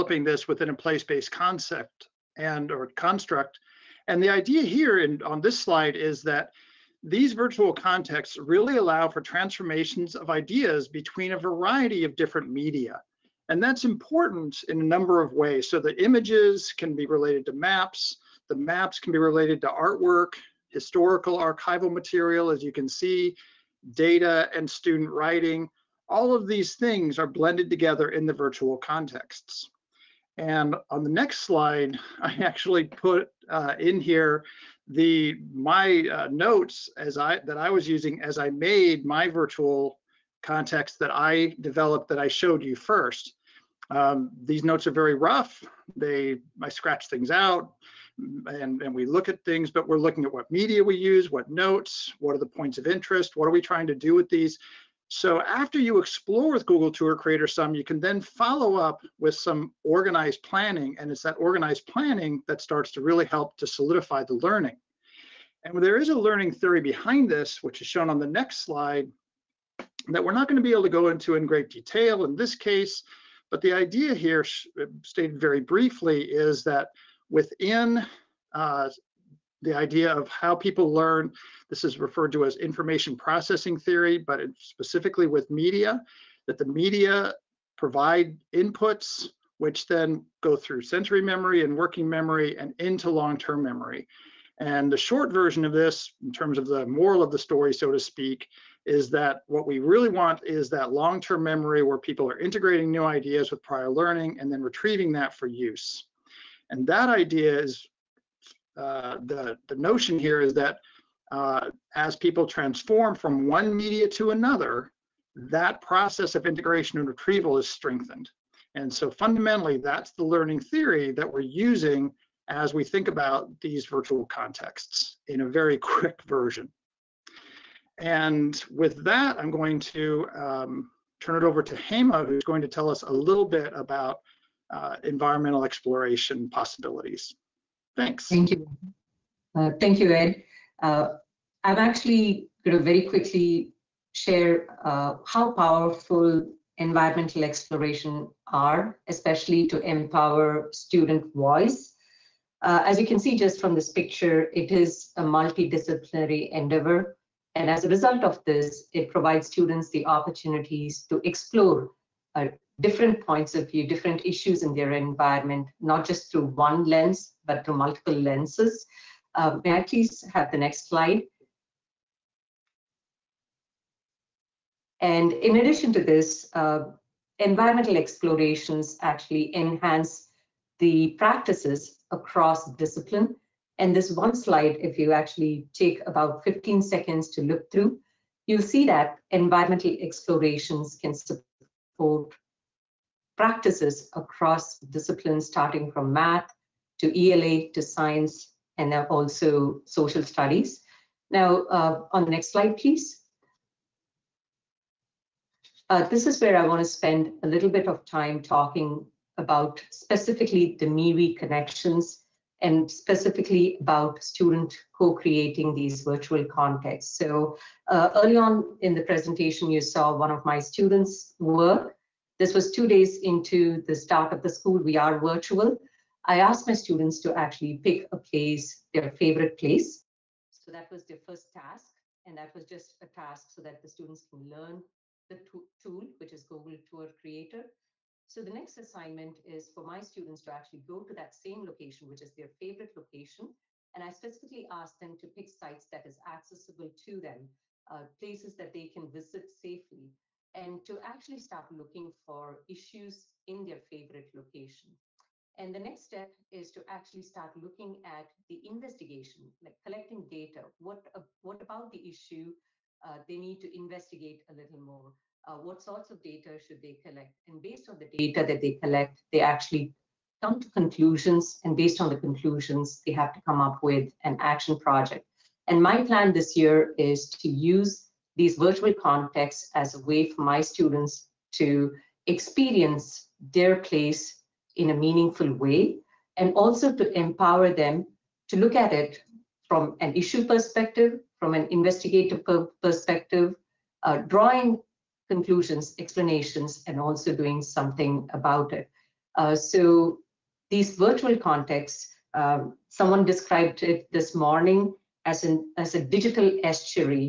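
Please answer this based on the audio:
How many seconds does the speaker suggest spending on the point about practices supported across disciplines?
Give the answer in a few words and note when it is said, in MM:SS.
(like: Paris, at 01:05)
15, at 03:06.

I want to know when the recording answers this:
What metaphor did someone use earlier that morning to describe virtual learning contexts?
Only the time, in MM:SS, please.
05:06.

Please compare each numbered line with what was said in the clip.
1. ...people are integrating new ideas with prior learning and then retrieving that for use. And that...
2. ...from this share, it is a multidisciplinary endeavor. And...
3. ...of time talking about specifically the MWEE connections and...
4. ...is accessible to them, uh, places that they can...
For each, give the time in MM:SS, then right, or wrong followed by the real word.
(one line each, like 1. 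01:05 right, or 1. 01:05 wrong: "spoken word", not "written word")
1. 01:41 right
2. 02:33 wrong: "picture", not "share"
3. 03:27 right
4. 04:06 right.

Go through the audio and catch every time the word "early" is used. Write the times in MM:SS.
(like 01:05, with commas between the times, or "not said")
03:38.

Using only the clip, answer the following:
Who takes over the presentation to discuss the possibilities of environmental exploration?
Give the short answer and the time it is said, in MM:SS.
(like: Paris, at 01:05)
Hema, at 02:11.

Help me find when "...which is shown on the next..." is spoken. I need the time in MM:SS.
01:07.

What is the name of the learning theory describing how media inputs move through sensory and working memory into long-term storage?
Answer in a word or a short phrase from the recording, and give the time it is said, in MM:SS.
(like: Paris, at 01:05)
information processing theory, at 01:22.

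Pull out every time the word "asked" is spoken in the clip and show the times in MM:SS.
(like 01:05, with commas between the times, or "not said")
03:46, 04:04.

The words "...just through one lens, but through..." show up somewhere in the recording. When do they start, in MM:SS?
02:46.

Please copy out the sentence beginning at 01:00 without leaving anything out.
And it's that organized planning that starts to really help to solidify the learning.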